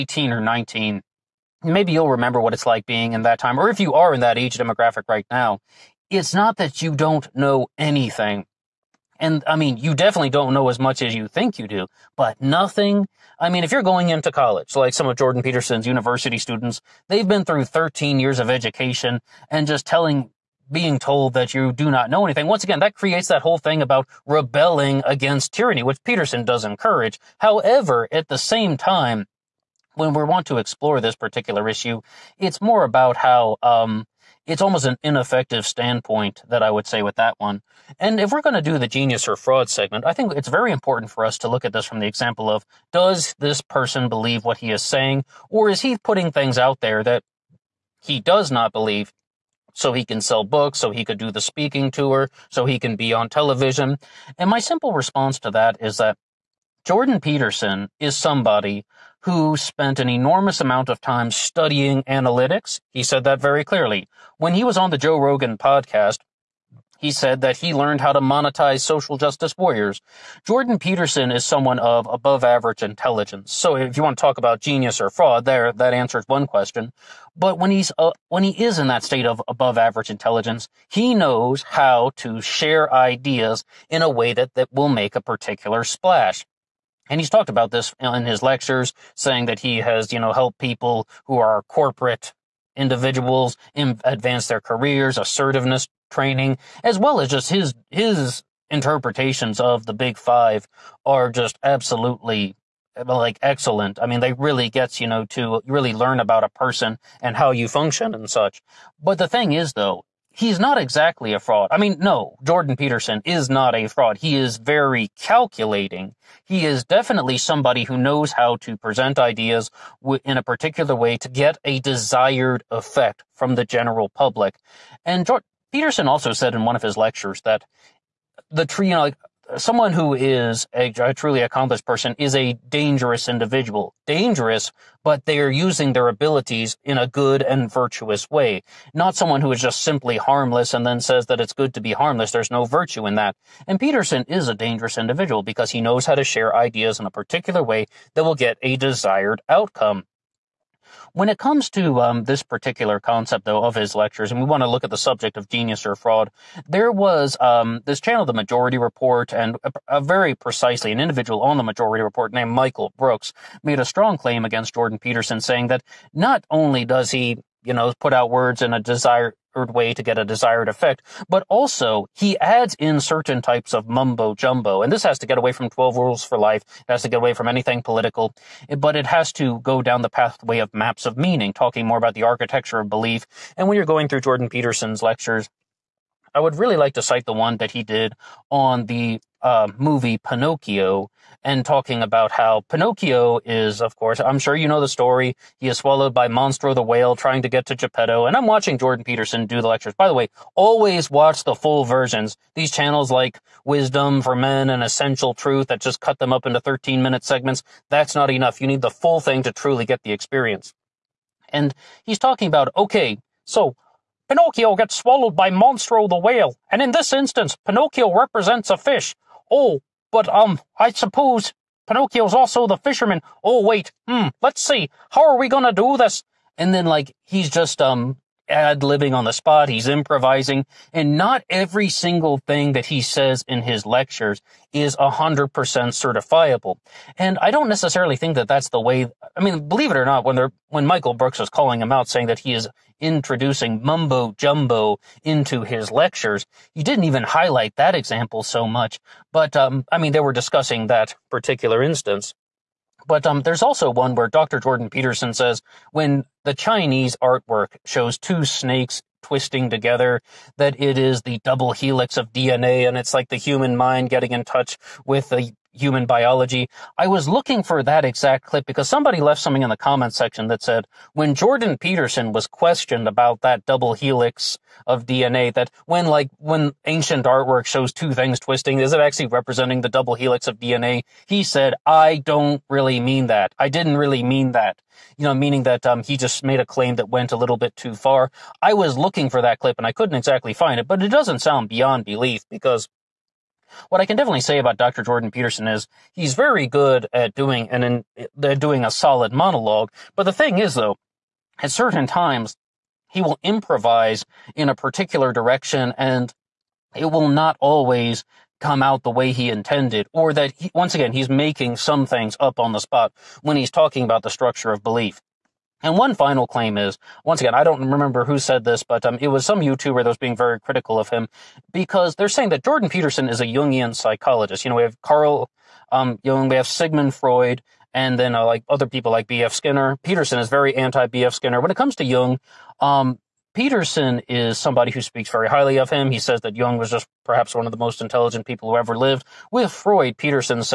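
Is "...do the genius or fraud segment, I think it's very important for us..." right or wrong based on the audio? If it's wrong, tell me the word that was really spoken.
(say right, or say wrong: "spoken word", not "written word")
right.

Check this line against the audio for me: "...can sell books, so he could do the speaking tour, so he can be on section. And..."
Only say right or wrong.
wrong.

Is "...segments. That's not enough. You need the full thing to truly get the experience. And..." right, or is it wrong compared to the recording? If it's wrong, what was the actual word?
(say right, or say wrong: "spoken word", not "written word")
right.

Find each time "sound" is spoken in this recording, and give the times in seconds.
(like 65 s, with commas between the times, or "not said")
291 s.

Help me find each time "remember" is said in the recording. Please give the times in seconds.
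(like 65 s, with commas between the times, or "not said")
2 s, 317 s.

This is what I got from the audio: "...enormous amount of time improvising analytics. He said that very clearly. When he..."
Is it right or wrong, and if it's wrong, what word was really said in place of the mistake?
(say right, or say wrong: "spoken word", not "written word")
wrong: "studying", not "improvising".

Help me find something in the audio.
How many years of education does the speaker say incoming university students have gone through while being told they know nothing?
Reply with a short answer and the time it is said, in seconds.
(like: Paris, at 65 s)
13, at 17 s.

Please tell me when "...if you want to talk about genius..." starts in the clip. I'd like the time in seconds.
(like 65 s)
73 s.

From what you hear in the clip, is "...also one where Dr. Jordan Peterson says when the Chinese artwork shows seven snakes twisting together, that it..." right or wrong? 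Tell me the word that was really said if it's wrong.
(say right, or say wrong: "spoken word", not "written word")
wrong: "two", not "seven".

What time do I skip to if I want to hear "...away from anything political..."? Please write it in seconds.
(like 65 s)
177 s.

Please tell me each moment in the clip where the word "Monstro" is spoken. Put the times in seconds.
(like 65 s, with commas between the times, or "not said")
196 s, 215 s.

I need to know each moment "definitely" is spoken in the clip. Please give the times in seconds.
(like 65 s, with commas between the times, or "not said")
9 s, 116 s, 294 s.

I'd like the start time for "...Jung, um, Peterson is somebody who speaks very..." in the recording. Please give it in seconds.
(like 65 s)
332 s.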